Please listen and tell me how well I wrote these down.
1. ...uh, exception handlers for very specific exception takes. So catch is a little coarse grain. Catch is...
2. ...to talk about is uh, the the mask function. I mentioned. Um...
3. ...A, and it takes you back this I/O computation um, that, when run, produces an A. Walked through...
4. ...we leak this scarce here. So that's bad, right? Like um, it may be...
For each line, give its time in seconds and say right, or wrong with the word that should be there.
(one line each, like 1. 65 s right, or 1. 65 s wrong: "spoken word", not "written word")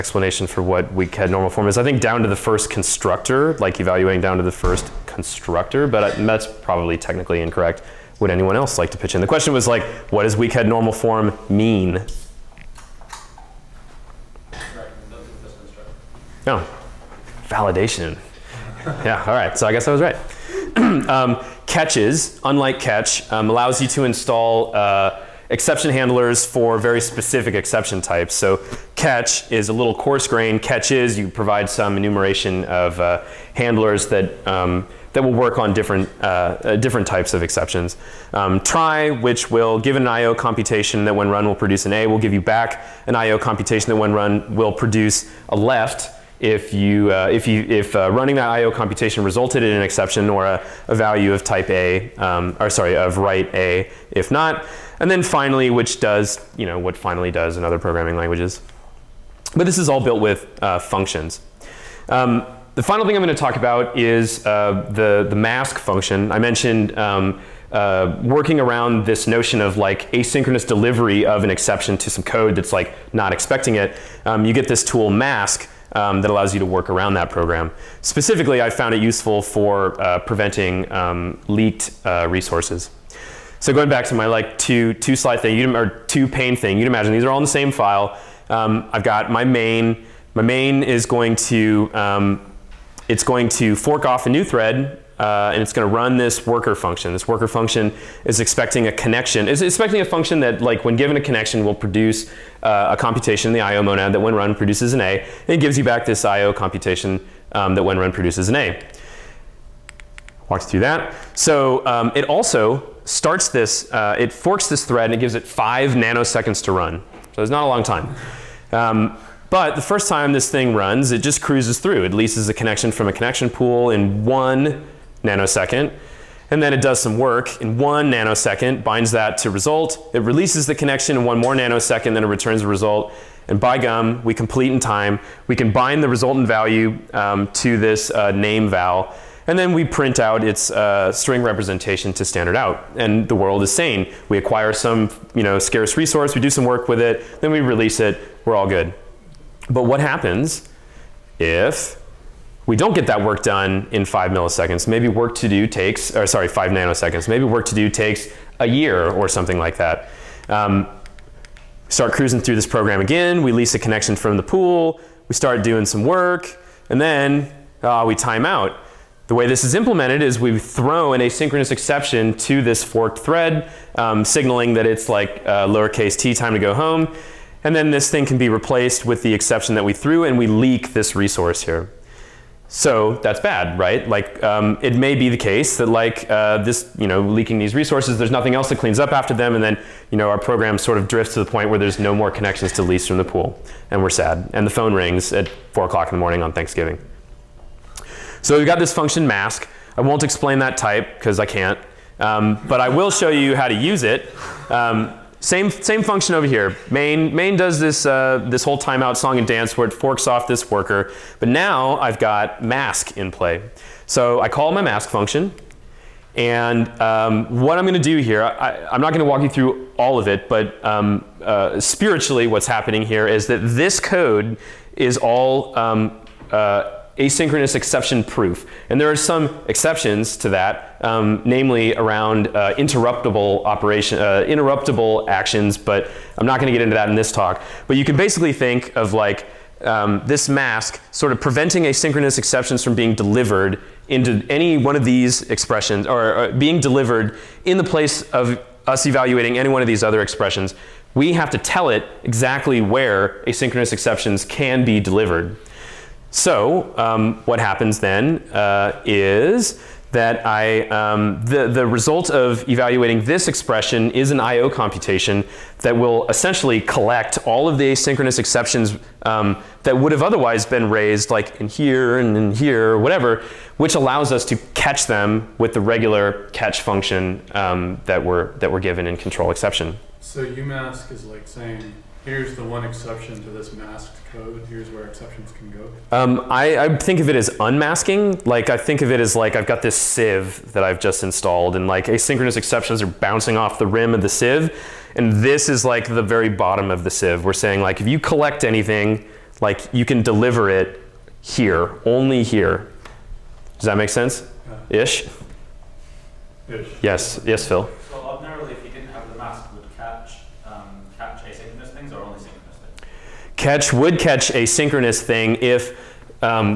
1. 24 s wrong: "types", not "takes"
2. 63 s right
3. 105 s wrong: "gives", not "takes"
4. 180 s wrong: "resource", not "scarce".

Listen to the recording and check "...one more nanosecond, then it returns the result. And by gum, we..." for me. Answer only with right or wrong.
right.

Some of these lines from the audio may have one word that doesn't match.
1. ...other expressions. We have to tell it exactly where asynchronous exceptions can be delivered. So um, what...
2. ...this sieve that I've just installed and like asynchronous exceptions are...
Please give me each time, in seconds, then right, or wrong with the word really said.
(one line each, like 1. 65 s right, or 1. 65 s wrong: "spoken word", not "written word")
1. 250 s right
2. 289 s right.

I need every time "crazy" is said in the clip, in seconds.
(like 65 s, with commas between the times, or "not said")
not said.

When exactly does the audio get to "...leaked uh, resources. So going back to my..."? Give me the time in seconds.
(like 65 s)
81 s.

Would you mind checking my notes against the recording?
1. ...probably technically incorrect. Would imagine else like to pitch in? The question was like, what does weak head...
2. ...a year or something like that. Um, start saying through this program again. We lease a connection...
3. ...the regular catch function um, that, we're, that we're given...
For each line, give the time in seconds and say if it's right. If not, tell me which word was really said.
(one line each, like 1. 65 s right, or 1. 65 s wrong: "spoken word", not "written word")
1. 6 s wrong: "anyone", not "imagine"
2. 158 s wrong: "cruising", not "saying"
3. 275 s right.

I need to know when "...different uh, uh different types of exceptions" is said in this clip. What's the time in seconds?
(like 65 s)
35 s.